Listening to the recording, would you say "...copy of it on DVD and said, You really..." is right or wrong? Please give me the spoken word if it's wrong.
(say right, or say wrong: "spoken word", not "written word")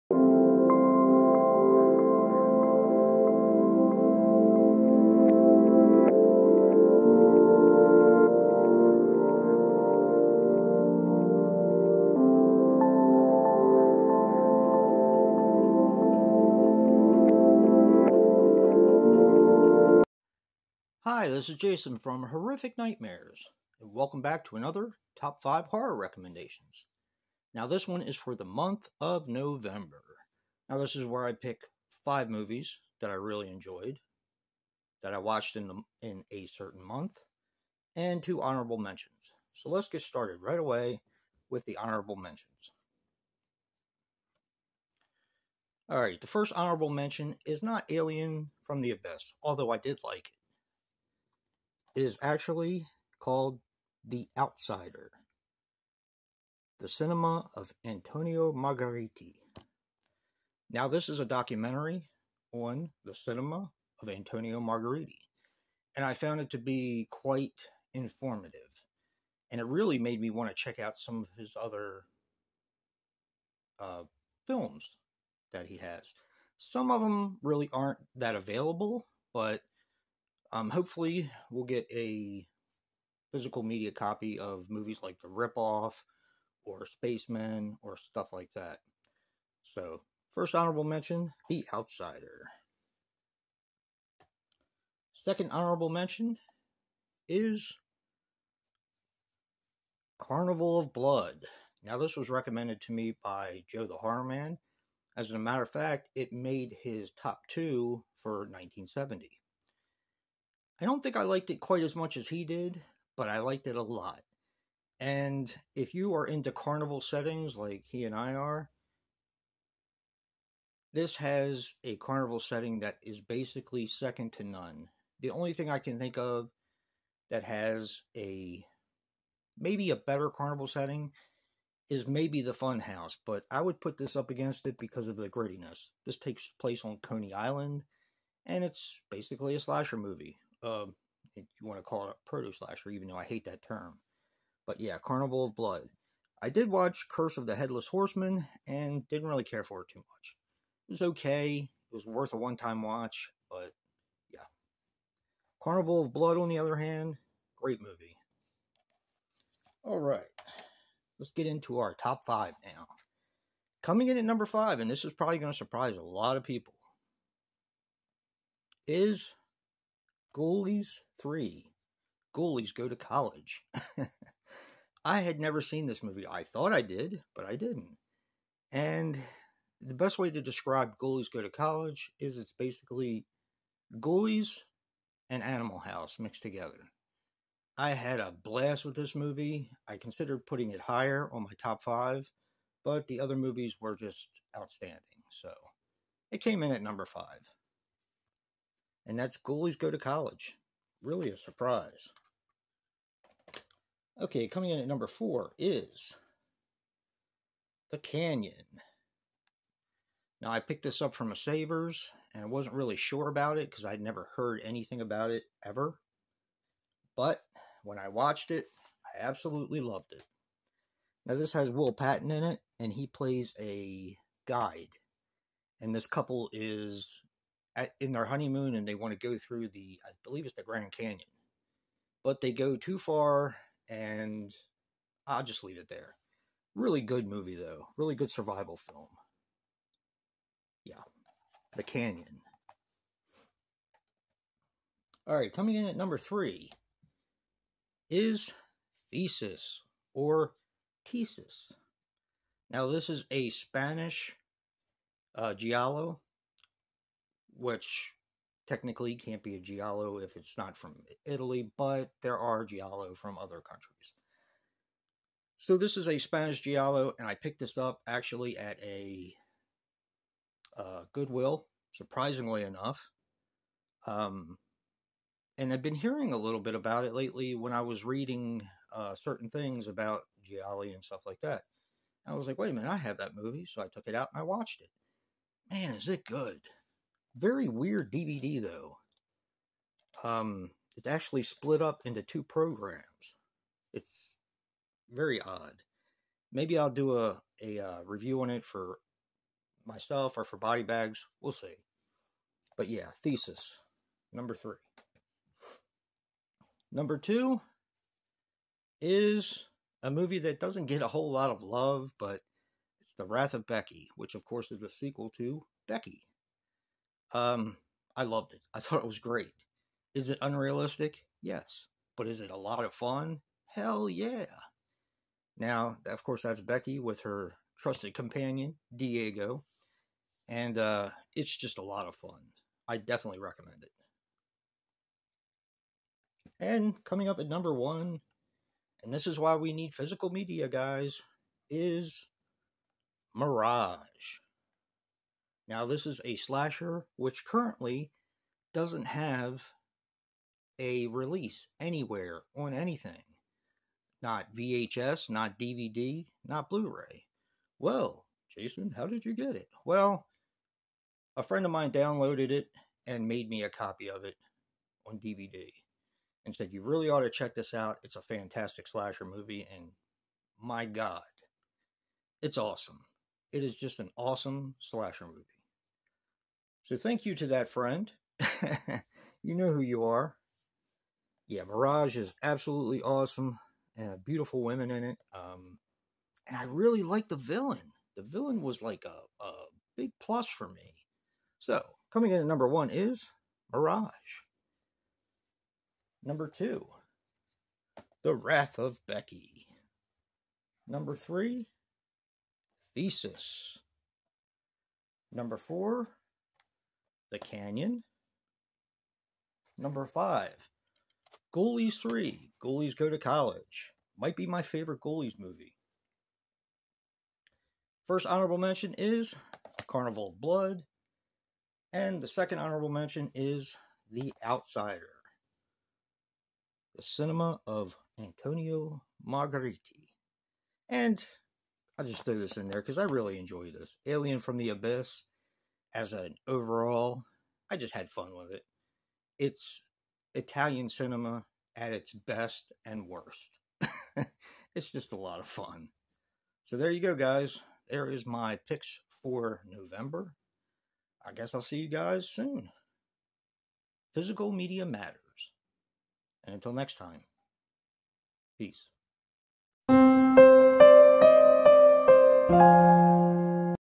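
right.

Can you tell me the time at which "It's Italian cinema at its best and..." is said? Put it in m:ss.
7:19.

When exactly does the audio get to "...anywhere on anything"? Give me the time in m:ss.
5:51.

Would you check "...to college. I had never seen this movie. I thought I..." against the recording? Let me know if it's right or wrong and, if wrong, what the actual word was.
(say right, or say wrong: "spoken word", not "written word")
right.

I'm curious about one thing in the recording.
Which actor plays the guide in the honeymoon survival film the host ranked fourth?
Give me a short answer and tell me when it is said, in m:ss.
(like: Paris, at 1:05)
Will Patton, at 3:41.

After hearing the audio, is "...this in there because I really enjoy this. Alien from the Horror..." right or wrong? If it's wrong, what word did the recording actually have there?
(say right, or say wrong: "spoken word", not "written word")
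wrong: "Abyss", not "Horror".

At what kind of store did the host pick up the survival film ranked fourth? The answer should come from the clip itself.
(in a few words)
Savers.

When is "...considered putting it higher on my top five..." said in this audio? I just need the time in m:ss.
3:09.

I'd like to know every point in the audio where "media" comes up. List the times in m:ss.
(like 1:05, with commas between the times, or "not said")
1:23, 5:40, 7:34.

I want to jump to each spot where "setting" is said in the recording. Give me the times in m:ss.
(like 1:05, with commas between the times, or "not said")
1:57, 2:02, 2:10.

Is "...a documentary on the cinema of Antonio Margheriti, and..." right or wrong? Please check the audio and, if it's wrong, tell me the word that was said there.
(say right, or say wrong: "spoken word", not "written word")
right.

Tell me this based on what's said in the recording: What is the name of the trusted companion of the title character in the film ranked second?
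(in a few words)
Diego.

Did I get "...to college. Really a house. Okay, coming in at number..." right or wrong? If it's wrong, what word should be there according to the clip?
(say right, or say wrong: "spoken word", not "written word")
wrong: "surprise", not "house".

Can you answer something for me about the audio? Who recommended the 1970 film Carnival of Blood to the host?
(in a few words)
Joe the Horror Man.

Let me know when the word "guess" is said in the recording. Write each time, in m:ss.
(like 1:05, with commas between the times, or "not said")
7:31.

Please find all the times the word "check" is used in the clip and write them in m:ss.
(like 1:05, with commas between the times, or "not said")
1:10, 6:07.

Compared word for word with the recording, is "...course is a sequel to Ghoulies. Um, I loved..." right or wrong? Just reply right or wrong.
wrong.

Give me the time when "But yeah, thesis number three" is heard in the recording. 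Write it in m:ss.
5:02.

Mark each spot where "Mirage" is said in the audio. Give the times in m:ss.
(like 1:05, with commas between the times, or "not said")
5:43, 6:21, 6:33.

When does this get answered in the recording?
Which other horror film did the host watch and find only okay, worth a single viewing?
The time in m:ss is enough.
2:27.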